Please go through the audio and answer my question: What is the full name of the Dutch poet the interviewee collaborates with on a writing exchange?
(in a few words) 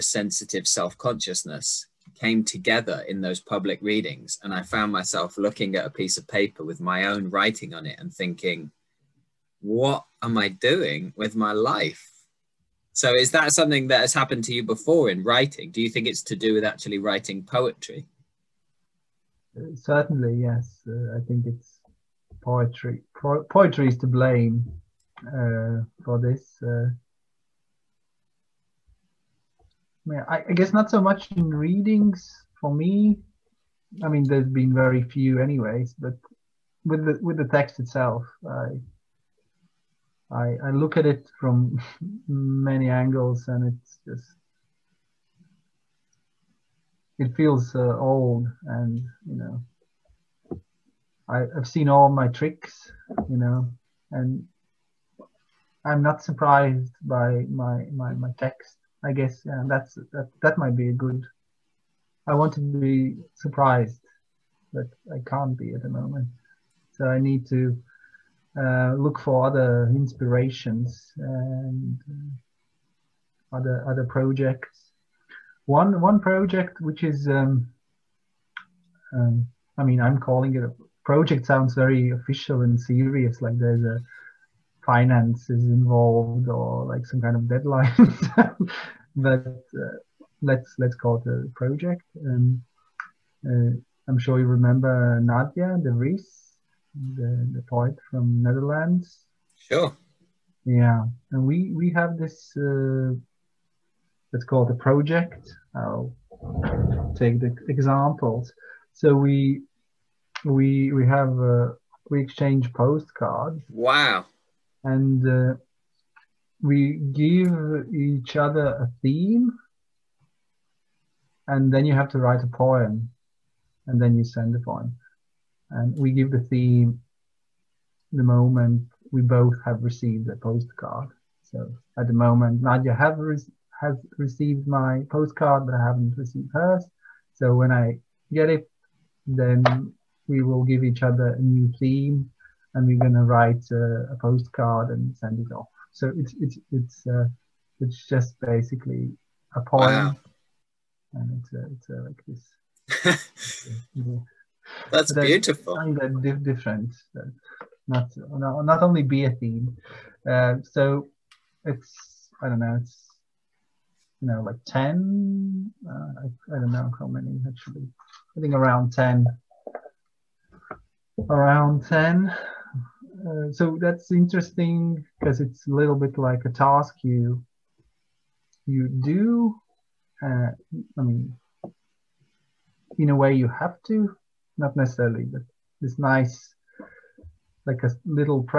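Nadia De Vries.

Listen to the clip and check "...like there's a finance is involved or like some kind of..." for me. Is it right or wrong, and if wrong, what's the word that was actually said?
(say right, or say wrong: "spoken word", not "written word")
right.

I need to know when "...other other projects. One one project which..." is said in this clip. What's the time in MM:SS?
01:13.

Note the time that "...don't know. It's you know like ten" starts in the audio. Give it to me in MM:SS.
02:42.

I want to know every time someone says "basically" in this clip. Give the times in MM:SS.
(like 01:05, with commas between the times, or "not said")
02:28.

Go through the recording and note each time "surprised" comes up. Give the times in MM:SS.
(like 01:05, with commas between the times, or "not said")
00:56, 01:03.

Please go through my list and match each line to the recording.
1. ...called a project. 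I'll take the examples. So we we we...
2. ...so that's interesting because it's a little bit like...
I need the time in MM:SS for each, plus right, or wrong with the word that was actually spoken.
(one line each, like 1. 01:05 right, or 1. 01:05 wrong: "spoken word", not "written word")
1. 01:44 right
2. 02:53 right.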